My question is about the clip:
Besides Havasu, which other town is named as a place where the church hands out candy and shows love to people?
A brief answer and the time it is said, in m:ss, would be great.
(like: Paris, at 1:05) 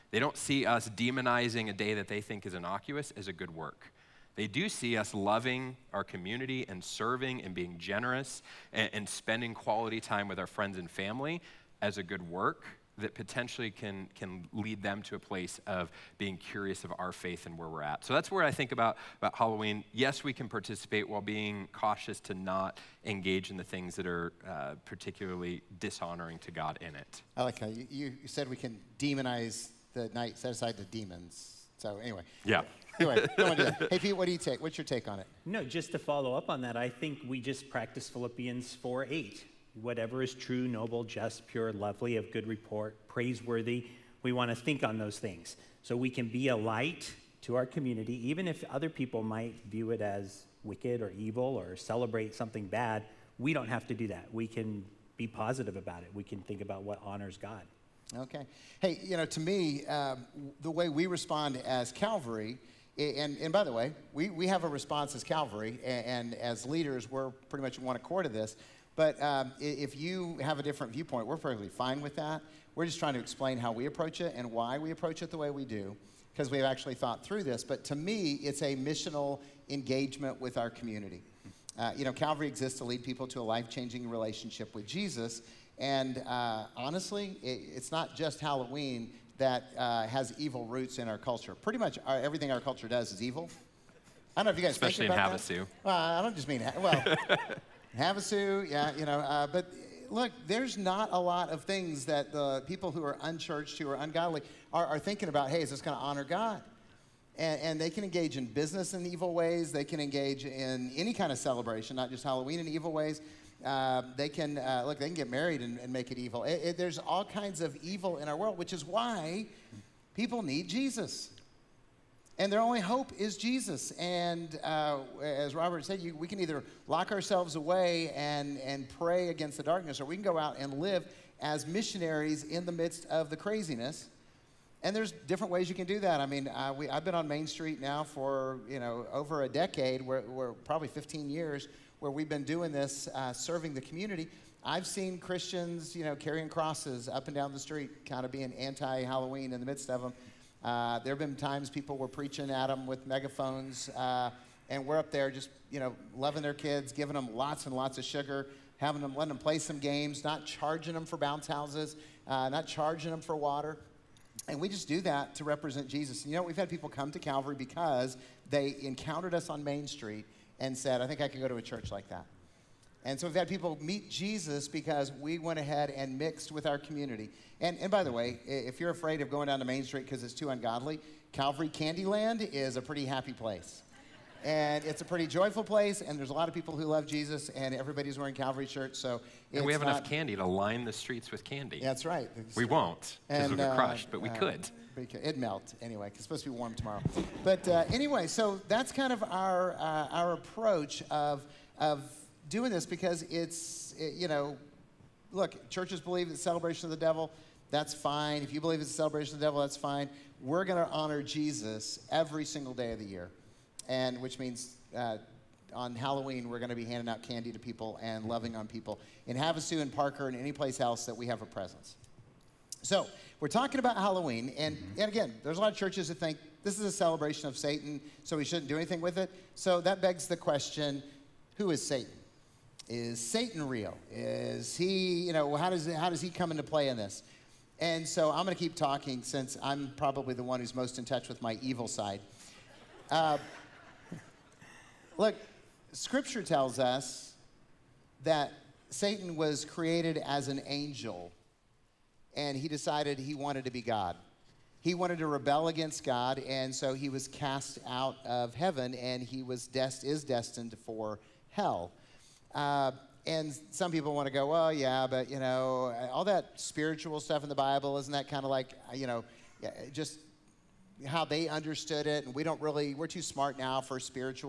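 Parker, at 3:39.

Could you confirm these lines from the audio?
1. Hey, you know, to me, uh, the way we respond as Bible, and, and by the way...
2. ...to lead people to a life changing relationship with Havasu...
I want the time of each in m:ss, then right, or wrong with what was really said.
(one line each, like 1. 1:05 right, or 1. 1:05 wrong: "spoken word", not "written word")
1. 0:58 wrong: "Calvary", not "Bible"
2. 1:22 wrong: "Jesus", not "Havasu".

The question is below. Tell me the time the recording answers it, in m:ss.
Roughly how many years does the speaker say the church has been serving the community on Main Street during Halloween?
2:20.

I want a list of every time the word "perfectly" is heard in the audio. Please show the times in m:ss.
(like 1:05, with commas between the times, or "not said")
1:11.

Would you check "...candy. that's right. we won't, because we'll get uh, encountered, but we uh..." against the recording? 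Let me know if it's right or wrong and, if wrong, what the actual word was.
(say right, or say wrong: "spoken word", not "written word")
wrong: "crushed", not "encountered".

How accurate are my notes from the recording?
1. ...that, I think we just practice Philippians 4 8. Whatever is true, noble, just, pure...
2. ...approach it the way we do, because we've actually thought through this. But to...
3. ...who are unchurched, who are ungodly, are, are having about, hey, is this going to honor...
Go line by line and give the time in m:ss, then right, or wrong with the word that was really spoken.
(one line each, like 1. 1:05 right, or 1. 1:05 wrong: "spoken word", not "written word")
1. 0:36 right
2. 1:14 right
3. 1:42 wrong: "thinking", not "having".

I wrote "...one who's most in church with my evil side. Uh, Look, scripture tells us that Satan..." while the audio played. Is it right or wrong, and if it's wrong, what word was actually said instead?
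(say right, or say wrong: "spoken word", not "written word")
wrong: "touch", not "church".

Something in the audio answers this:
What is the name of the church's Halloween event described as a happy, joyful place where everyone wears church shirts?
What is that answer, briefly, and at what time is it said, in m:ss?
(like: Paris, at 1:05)
Calvary Candyland, at 3:01.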